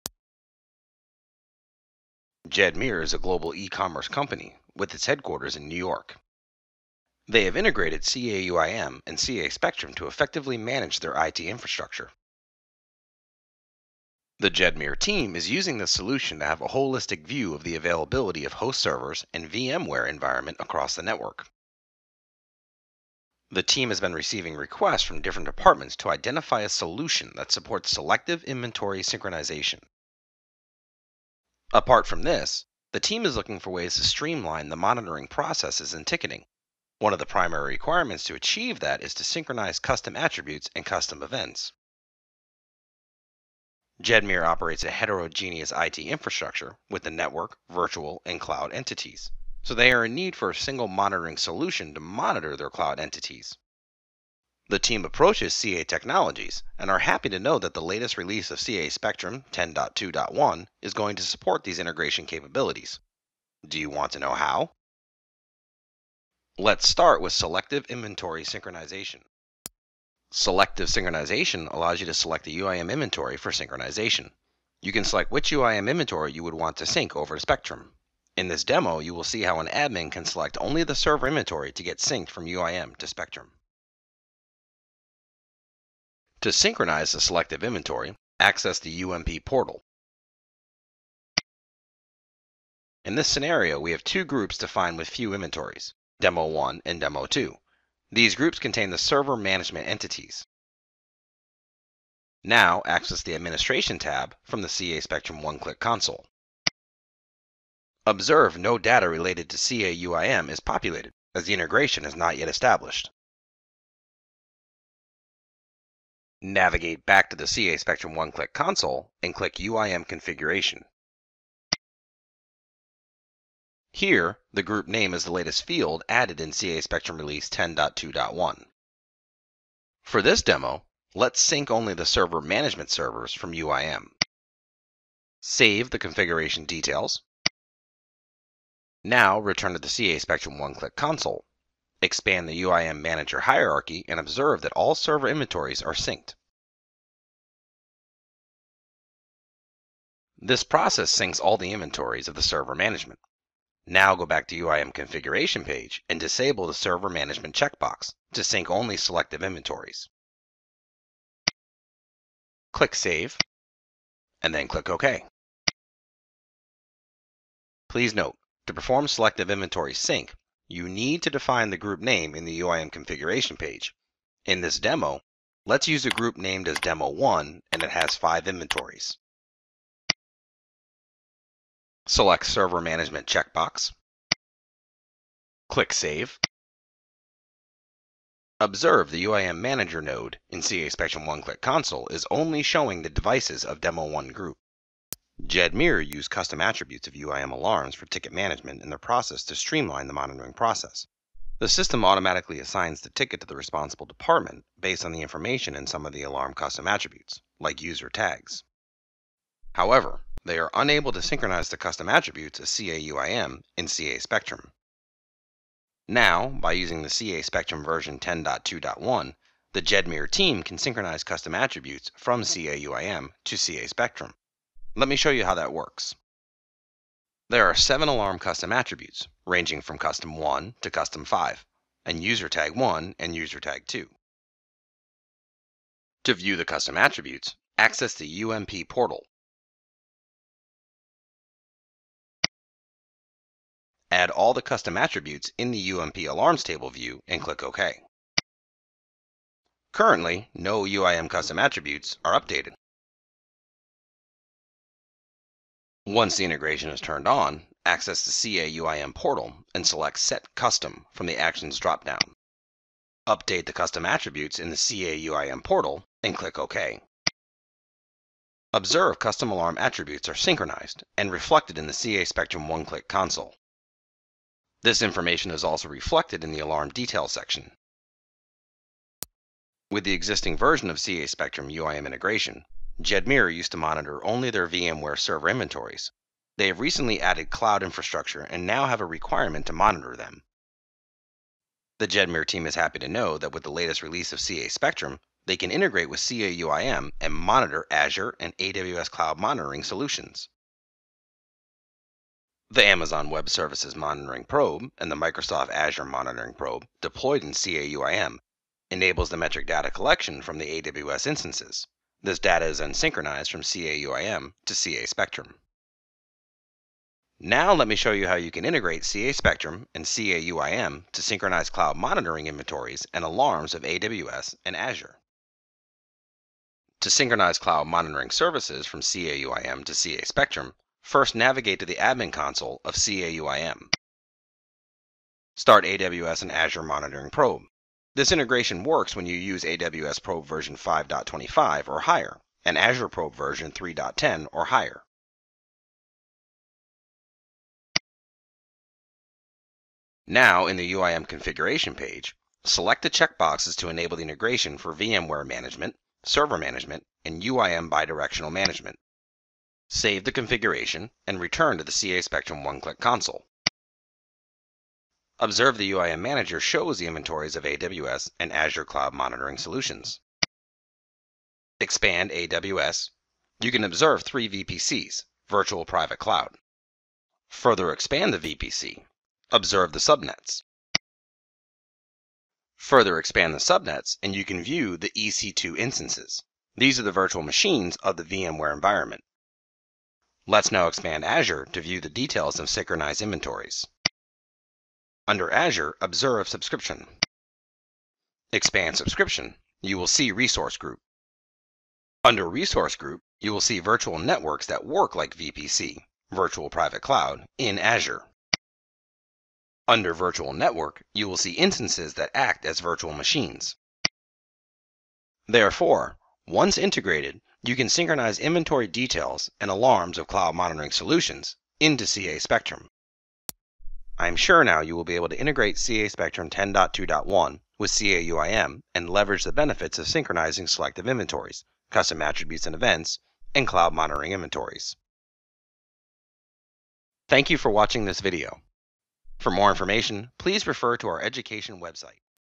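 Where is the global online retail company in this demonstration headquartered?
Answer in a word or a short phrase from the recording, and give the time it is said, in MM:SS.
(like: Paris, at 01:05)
New York, at 00:05.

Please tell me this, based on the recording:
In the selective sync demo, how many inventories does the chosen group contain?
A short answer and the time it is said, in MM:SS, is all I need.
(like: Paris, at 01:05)
5, at 02:58.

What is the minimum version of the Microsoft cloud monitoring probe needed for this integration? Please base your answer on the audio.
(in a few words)
3.10.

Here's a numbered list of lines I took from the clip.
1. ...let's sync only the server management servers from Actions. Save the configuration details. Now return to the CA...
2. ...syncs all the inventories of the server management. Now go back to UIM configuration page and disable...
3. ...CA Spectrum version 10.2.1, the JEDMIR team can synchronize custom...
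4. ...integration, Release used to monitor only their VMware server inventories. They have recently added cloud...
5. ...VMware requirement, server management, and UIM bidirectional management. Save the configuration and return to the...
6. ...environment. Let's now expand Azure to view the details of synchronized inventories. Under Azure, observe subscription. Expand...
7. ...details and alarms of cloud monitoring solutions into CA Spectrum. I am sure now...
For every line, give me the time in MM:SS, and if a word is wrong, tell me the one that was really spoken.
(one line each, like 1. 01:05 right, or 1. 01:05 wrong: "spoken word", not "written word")
1. 02:11 wrong: "UIM", not "Actions"
2. 02:31 right
3. 03:37 right
4. 04:42 wrong: "Jedmir", not "Release"
5. 05:54 wrong: "management", not "requirement"
6. 06:28 right
7. 06:58 right.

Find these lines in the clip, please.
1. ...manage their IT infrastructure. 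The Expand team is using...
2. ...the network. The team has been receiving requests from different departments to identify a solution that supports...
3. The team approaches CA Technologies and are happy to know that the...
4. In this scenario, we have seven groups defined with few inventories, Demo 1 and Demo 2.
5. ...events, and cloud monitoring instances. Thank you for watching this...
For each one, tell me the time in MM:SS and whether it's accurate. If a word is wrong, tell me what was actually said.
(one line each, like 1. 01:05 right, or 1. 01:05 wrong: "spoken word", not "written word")
1. 00:10 wrong: "Jedmir", not "Expand"
2. 00:20 right
3. 00:54 right
4. 01:33 wrong: "two", not "seven"
5. 07:12 wrong: "inventories", not "instances".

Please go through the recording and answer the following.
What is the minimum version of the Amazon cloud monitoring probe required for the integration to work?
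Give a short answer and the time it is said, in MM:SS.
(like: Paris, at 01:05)
5.25, at 05:40.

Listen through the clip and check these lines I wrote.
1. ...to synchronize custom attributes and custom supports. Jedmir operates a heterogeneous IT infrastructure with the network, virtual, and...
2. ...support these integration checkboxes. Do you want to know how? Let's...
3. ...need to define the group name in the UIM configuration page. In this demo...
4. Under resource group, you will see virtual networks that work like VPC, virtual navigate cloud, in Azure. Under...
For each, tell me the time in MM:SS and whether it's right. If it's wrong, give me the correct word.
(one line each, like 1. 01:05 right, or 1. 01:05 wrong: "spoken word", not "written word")
1. 00:39 wrong: "events", not "supports"
2. 01:01 wrong: "capabilities", not "checkboxes"
3. 02:50 right
4. 06:42 wrong: "private", not "navigate".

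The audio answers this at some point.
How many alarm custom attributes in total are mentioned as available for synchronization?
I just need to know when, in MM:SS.
03:47.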